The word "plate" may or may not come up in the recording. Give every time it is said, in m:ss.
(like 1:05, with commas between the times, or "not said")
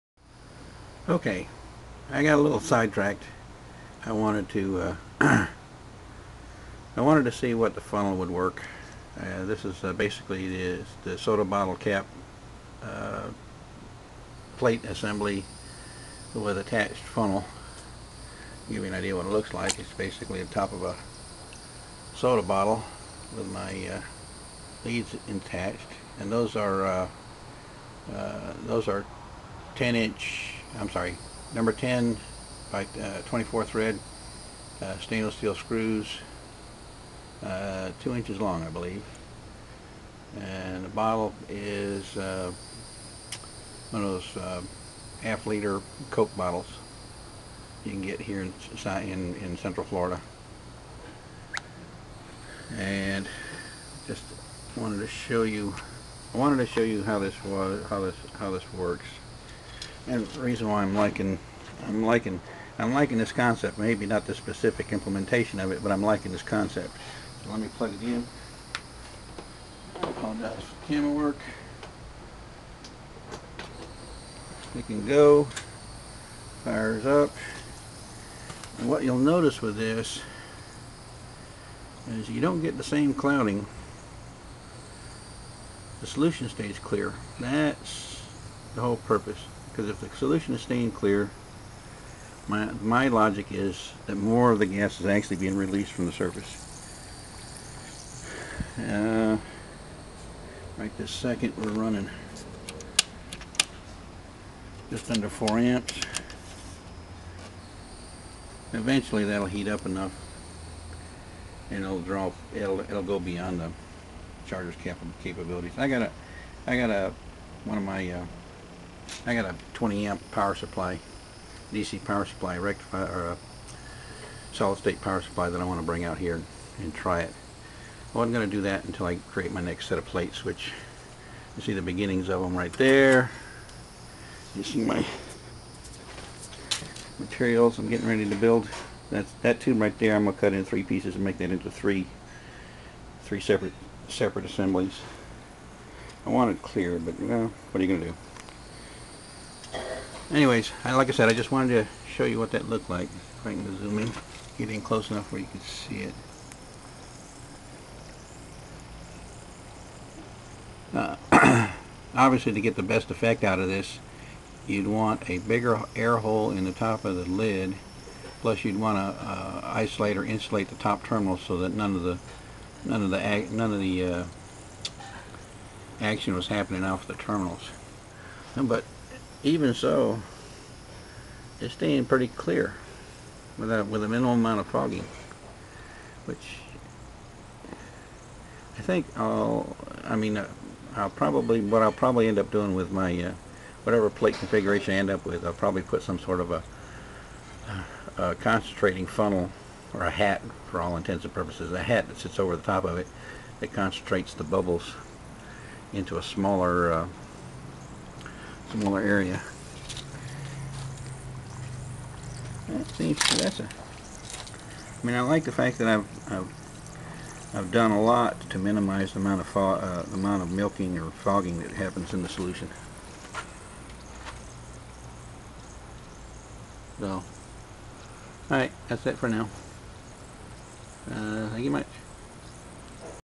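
0:14, 2:10, 3:14.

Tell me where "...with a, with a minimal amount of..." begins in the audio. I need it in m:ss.
3:03.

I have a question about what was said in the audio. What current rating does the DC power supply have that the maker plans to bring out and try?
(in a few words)
20 amp.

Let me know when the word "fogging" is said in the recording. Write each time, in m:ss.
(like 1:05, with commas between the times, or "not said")
3:04, 3:41.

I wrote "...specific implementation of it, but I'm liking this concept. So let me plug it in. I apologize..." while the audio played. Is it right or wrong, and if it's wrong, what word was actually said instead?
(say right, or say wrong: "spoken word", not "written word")
right.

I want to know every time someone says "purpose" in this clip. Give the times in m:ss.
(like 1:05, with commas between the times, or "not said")
1:28, 3:21.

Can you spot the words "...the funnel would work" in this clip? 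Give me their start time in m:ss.
0:07.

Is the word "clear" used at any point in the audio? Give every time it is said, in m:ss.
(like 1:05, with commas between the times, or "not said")
1:26, 1:30, 2:26, 3:02.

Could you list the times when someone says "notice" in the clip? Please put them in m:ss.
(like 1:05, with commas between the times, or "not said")
1:19.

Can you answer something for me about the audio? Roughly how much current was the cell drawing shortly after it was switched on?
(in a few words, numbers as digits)
just under 4 amps.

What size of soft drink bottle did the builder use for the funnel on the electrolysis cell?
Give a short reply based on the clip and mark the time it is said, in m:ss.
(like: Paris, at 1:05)
half liter, at 0:45.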